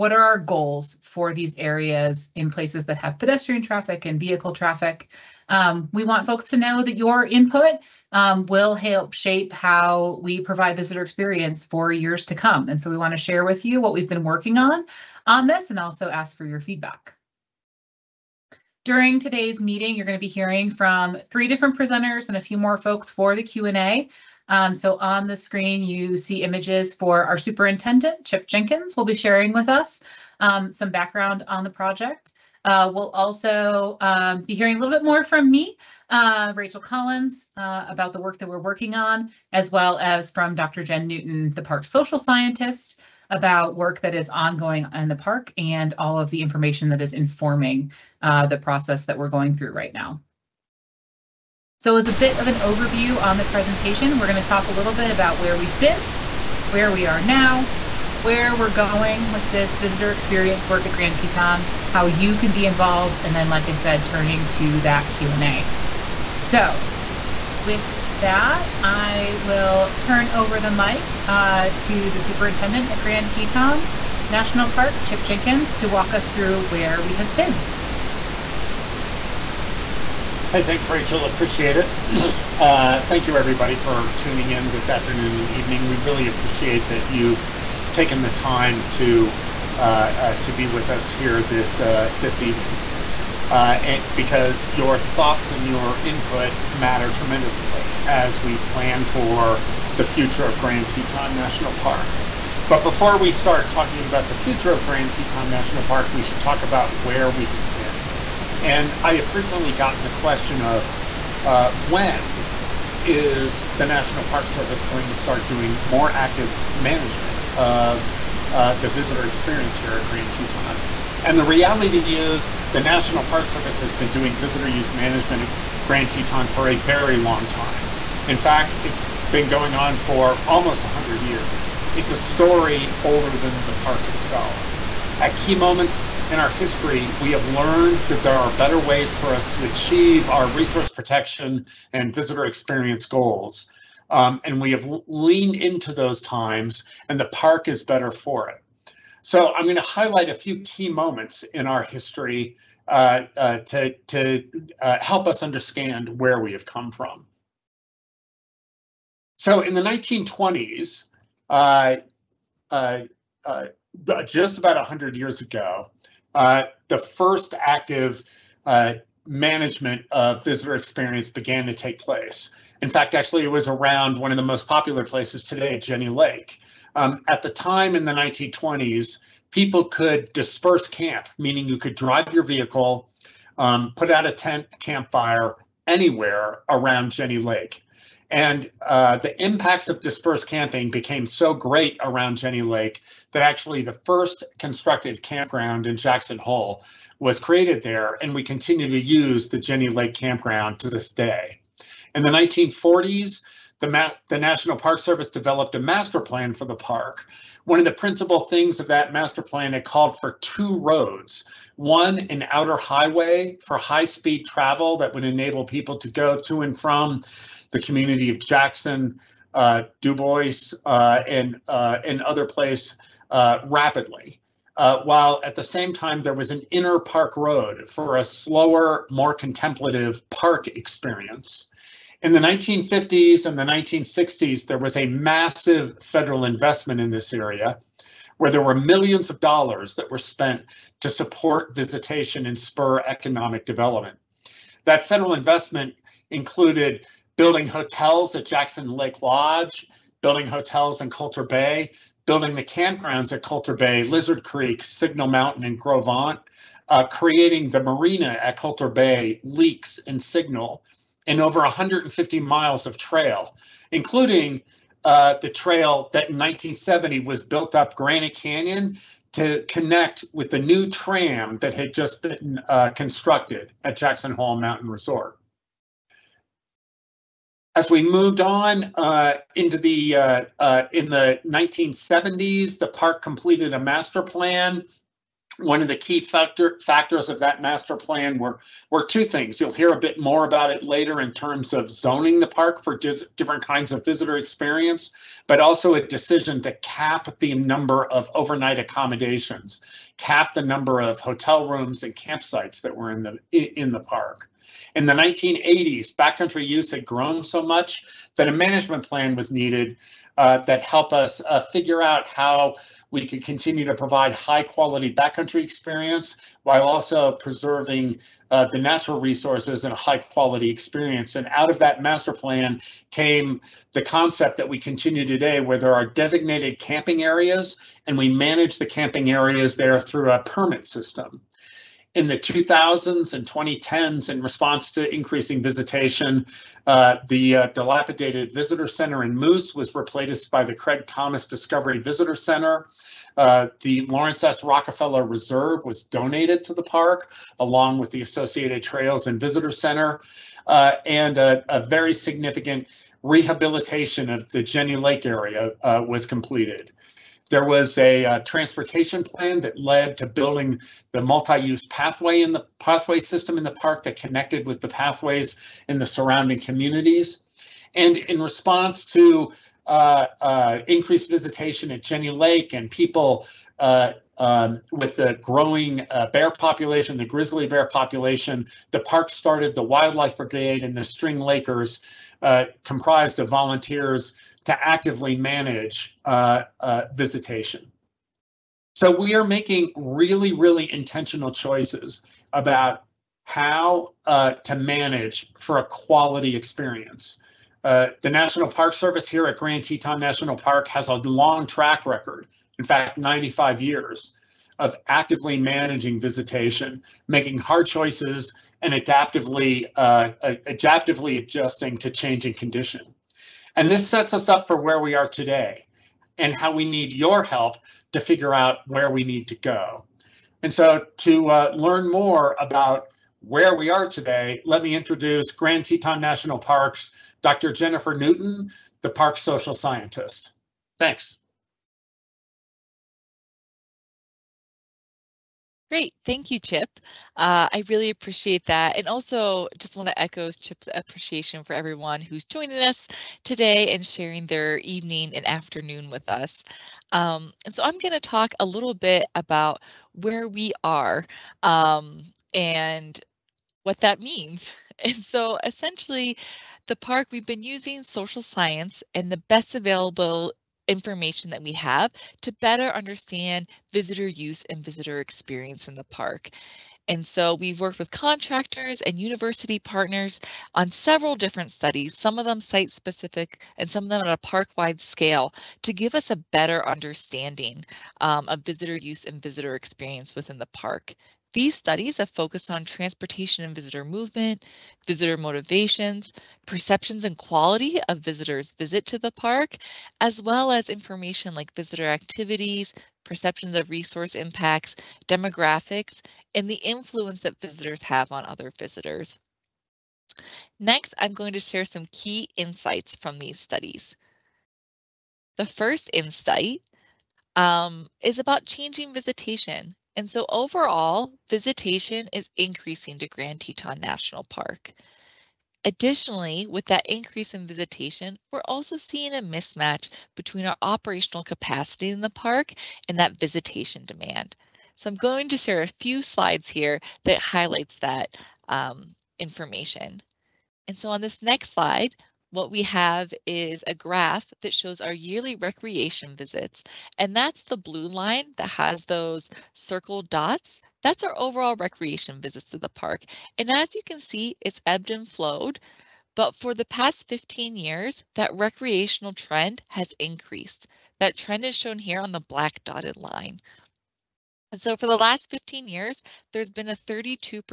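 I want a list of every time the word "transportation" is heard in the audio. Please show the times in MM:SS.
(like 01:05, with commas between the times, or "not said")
05:58, 08:02.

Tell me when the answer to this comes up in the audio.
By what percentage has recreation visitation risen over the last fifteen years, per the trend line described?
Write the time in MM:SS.
09:16.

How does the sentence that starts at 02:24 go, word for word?
Um, and we have leaned into those times, and the park is better for it.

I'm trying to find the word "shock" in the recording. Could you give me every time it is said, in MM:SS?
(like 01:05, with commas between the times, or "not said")
not said.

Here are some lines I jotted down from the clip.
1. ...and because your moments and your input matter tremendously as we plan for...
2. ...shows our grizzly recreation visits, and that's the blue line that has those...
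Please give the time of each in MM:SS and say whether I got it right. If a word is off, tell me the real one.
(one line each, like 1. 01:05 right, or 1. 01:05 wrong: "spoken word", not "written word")
1. 01:33 wrong: "thoughts", not "moments"
2. 08:54 wrong: "yearly", not "grizzly".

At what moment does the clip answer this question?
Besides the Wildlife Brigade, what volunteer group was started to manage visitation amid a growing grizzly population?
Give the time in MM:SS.
06:21.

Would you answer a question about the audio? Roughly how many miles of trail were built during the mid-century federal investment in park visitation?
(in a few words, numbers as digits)
150.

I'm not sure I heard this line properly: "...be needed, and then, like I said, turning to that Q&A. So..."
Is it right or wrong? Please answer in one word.
wrong.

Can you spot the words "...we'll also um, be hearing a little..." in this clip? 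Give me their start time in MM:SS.
00:32.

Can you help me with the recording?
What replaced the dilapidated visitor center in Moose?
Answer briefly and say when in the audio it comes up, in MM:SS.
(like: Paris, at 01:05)
Craig Thomas Discovery Visitor Center, at 05:40.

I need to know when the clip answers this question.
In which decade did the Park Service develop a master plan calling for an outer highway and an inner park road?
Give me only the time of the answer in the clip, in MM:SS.
03:22.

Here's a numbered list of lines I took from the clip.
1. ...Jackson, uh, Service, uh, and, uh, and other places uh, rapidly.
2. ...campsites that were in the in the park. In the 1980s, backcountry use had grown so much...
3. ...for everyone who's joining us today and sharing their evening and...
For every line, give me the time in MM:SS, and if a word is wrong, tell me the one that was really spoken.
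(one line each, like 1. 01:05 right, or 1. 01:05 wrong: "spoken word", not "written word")
1. 03:38 wrong: "Dubois", not "Service"
2. 05:02 right
3. 07:21 right.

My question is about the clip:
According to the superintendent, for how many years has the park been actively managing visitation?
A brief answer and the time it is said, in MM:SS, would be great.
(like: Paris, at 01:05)
95, at 06:43.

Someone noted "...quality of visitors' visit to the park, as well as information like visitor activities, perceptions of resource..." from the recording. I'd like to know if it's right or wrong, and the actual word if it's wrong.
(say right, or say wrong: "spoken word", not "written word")
right.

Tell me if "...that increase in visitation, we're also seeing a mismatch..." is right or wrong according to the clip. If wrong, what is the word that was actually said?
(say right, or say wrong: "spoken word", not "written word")
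right.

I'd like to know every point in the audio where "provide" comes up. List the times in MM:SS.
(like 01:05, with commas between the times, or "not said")
00:10, 05:13.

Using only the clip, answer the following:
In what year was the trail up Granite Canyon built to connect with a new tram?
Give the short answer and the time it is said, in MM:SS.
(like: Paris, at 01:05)
1970, at 04:26.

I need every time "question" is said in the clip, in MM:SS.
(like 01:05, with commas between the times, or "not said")
01:50.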